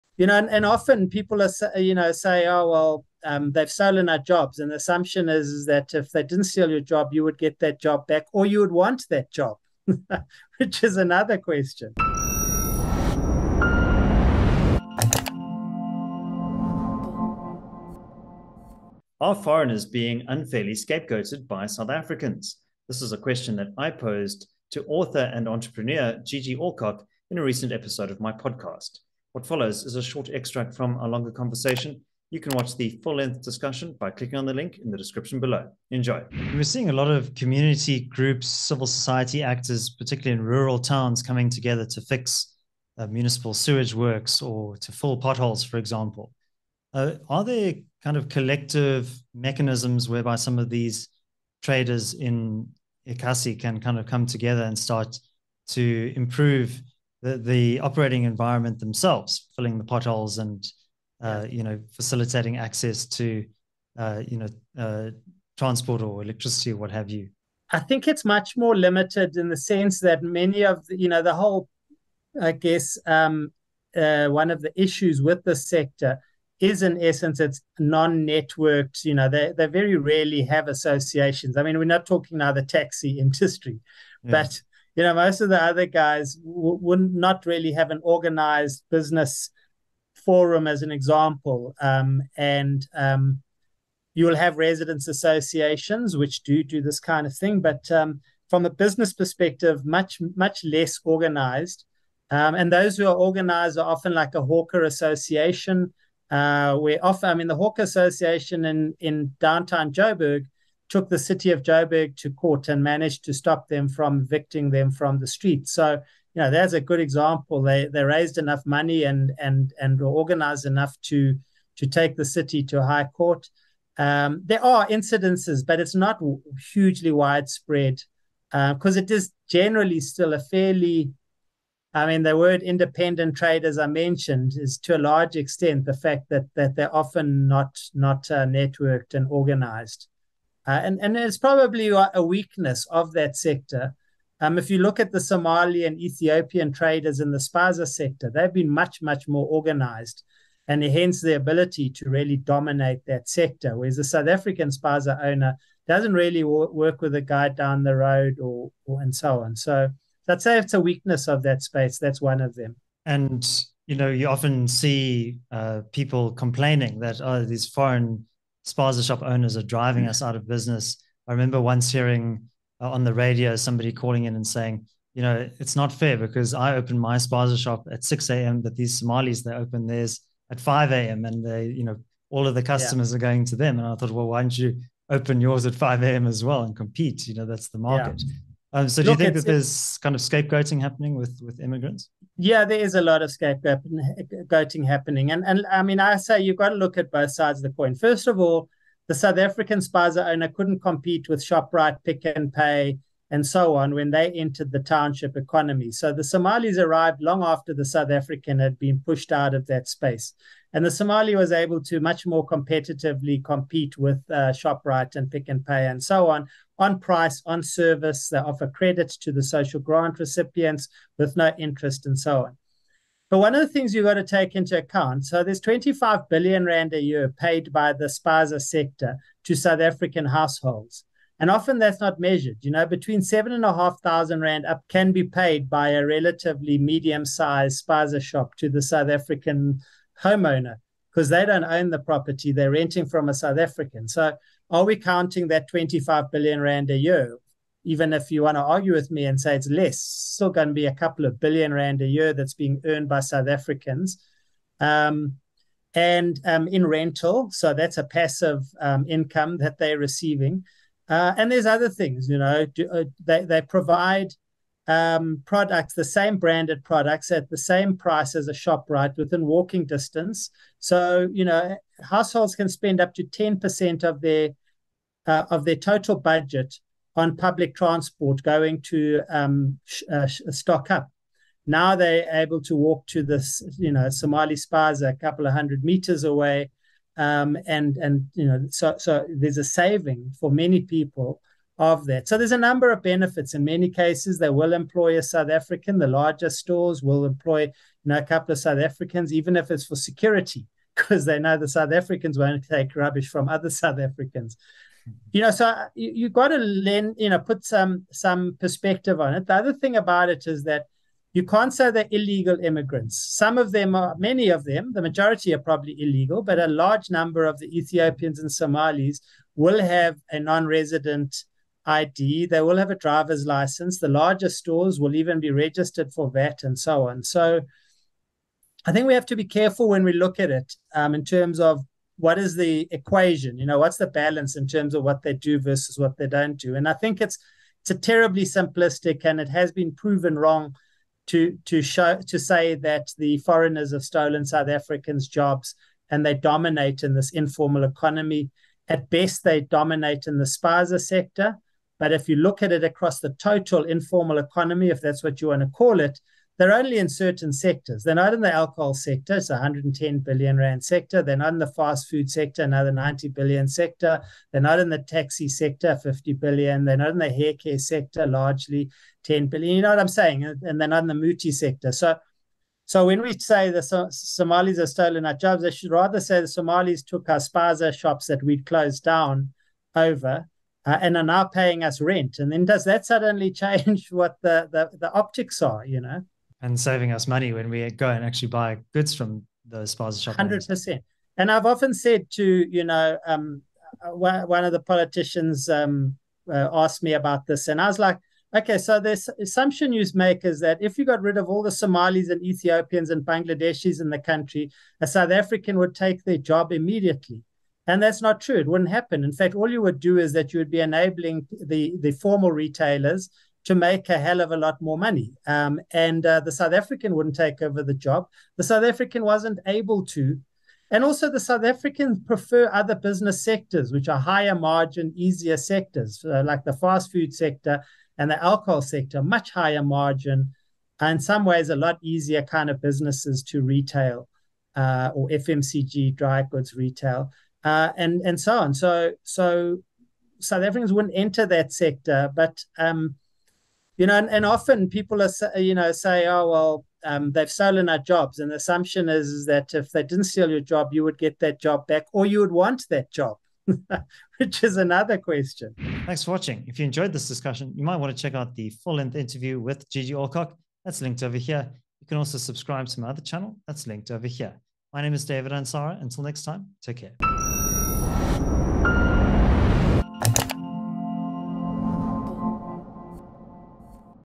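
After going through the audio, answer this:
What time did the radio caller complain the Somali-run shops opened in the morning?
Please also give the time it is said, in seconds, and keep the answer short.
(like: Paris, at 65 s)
5 a.m., at 179 s.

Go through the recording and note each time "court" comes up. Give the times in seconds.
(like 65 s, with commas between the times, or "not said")
112 s, 123 s.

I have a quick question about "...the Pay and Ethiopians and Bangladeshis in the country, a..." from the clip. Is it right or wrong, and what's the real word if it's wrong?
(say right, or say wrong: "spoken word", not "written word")
wrong: "Somalis", not "Pay".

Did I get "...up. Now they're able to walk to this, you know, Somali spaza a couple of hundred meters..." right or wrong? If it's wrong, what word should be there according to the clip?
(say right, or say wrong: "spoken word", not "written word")
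right.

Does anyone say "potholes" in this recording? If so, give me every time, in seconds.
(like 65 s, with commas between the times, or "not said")
45 s, 59 s.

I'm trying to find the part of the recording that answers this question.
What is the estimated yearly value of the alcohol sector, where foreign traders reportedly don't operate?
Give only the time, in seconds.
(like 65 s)
359 s.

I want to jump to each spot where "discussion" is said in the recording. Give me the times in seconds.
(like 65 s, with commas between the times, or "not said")
33 s, 457 s.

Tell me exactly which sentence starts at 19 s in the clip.
Are foreigners being unfairly scapegoated by South Africans?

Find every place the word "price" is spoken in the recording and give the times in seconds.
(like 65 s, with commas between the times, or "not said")
216 s, 267 s.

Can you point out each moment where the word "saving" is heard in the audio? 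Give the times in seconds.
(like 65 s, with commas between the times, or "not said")
289 s, 386 s.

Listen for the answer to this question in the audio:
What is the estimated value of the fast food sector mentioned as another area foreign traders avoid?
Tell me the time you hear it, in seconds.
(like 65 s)
362 s.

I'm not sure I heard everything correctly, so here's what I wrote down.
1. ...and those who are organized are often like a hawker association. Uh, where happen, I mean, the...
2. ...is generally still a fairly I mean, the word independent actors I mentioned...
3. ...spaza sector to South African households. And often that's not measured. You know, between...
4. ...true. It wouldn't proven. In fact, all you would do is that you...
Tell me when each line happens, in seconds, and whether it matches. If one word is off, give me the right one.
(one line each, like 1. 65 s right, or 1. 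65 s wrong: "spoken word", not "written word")
1. 102 s wrong: "often", not "happen"
2. 129 s wrong: "traders", not "actors"
3. 228 s right
4. 408 s wrong: "happen", not "proven".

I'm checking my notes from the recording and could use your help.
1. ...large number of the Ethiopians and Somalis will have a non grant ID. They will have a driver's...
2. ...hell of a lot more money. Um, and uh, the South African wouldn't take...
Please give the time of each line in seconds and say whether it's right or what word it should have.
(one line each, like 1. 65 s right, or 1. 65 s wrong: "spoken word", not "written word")
1. 316 s wrong: "resident", not "grant"
2. 414 s right.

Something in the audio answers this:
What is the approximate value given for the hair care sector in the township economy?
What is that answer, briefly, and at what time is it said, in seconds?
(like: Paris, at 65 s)
10 billion, at 369 s.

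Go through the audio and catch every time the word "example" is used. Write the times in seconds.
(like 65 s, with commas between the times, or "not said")
45 s, 90 s, 116 s.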